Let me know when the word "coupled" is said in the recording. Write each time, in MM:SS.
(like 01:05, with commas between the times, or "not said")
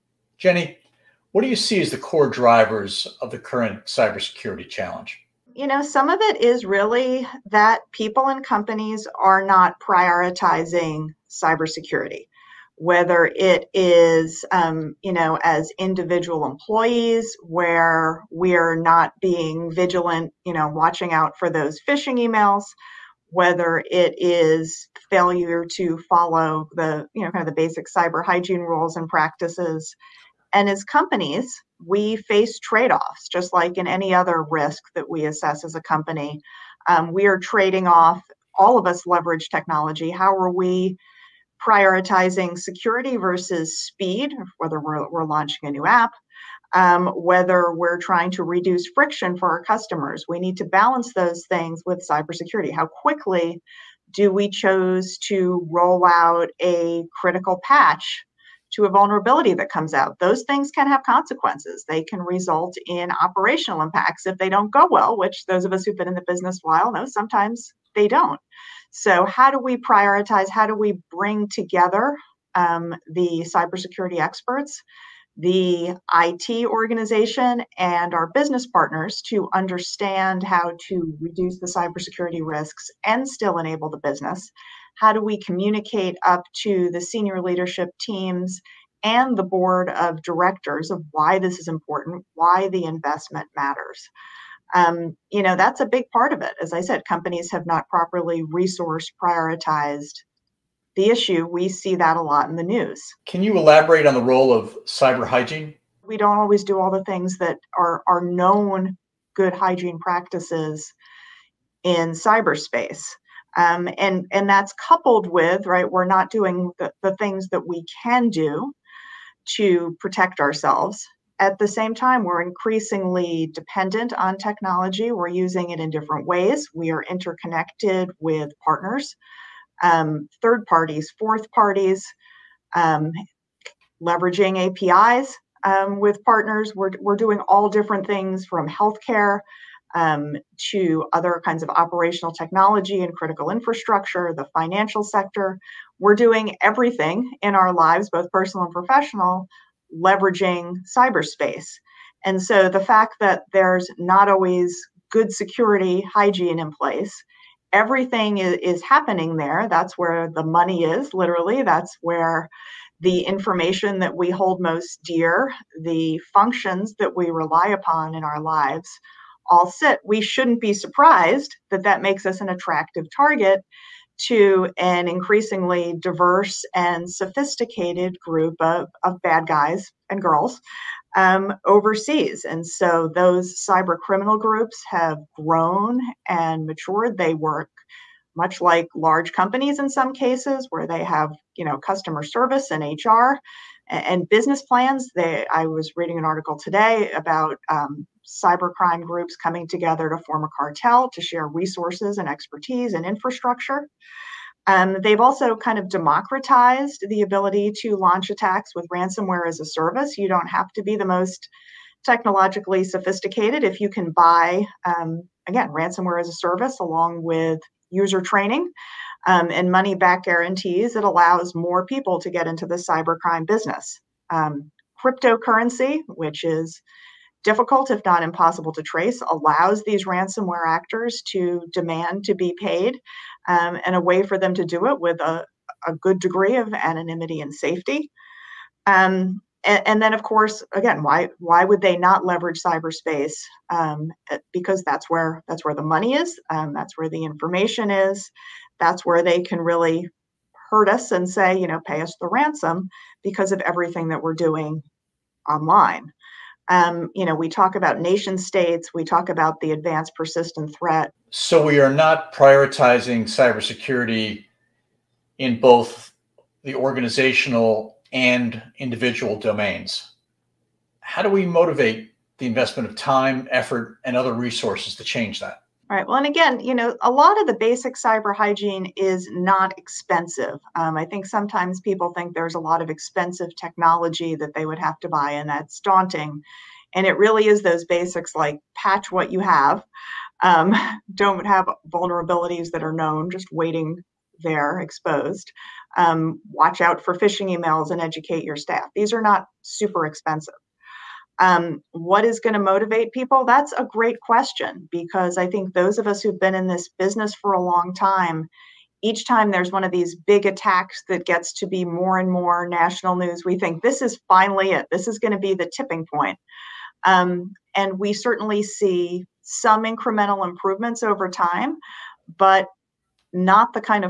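01:54.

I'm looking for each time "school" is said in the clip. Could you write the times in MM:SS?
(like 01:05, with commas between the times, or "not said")
not said.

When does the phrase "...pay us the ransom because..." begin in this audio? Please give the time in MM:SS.
04:11.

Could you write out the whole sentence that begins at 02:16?
We're, we're doing all different things from healthcare um, to other kinds of operational technology and critical infrastructure, the financial sector.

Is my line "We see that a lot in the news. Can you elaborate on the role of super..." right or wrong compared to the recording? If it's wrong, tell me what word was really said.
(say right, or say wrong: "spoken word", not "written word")
wrong: "cyber", not "super".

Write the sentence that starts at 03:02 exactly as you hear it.
And so those cyber criminal groups have grown and matured.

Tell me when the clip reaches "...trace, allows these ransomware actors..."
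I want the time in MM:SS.
03:48.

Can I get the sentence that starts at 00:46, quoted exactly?
Um, whether we're trying to reduce friction for our customers, we need to balance those things with cybersecurity.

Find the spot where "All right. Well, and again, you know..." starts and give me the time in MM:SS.
04:35.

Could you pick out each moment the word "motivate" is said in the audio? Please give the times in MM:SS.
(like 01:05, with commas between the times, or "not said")
04:31, 05:02.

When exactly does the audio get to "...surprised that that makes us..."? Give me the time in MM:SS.
02:50.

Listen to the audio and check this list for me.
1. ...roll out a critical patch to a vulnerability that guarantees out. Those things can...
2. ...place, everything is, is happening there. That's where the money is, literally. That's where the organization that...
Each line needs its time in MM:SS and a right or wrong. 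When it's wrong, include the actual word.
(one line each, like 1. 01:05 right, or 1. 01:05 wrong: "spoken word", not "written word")
1. 00:55 wrong: "comes", not "guarantees"
2. 02:36 wrong: "information", not "organization".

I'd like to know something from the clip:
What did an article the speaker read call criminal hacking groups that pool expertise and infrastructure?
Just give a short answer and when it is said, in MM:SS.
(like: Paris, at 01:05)
a cartel, at 03:20.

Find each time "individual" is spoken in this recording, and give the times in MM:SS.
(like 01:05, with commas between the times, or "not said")
00:15, 04:28.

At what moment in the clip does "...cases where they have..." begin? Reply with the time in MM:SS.
03:10.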